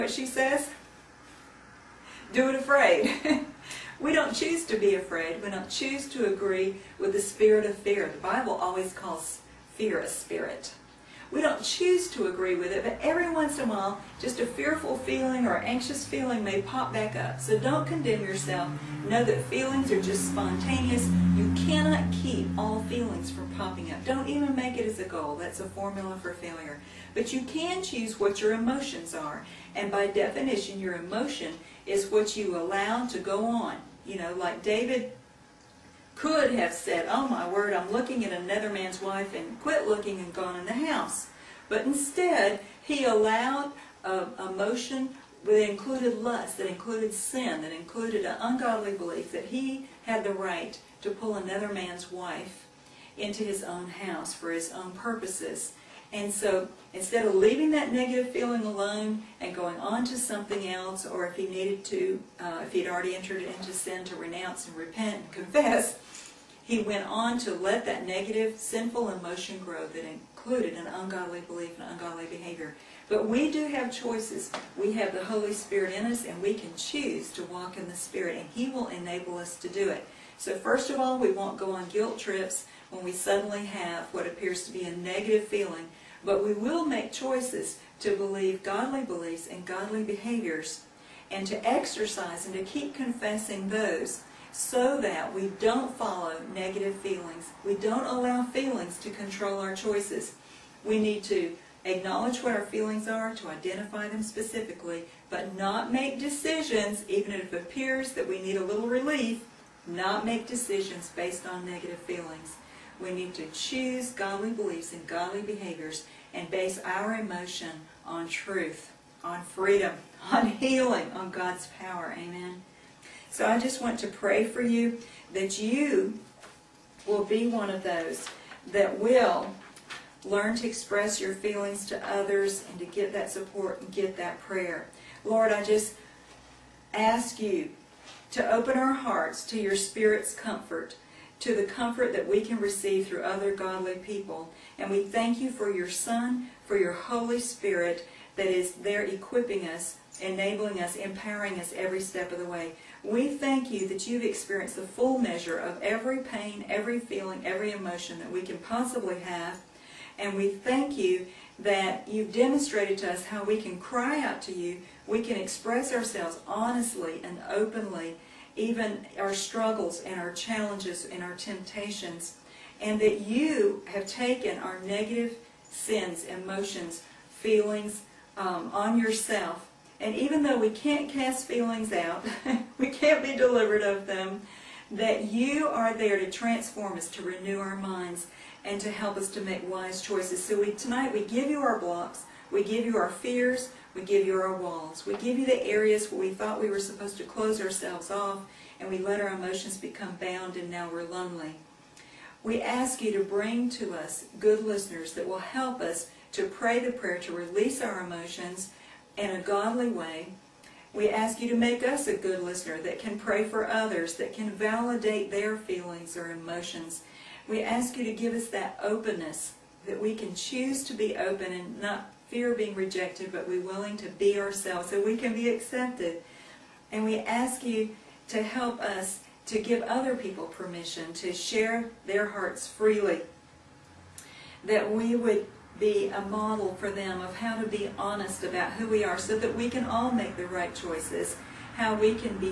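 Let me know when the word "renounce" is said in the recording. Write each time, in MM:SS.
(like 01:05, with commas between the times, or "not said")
01:04.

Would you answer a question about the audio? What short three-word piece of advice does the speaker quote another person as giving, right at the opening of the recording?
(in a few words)
Do it afraid.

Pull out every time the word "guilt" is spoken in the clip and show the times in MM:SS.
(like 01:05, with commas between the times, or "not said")
01:21.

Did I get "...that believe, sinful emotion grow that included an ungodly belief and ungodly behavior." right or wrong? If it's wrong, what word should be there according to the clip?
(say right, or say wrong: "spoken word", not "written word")
wrong: "negative", not "believe".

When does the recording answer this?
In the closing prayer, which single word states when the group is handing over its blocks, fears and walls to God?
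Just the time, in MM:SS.
03:10.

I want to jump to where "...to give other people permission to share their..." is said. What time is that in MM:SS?
03:49.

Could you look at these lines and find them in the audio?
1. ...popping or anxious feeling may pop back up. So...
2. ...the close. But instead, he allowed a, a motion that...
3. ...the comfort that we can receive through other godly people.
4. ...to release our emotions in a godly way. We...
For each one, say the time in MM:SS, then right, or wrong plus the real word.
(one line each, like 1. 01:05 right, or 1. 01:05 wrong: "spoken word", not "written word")
1. 00:14 wrong: "feeling", not "popping"
2. 00:40 wrong: "house", not "close"
3. 02:21 right
4. 03:27 right.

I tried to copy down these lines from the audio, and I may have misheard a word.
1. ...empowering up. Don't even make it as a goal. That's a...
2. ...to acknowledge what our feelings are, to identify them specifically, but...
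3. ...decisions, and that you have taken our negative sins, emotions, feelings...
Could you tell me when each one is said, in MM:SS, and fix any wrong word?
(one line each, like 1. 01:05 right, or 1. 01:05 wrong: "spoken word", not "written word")
1. 00:23 wrong: "popping", not "empowering"
2. 01:41 right
3. 02:51 wrong: "temptations", not "decisions".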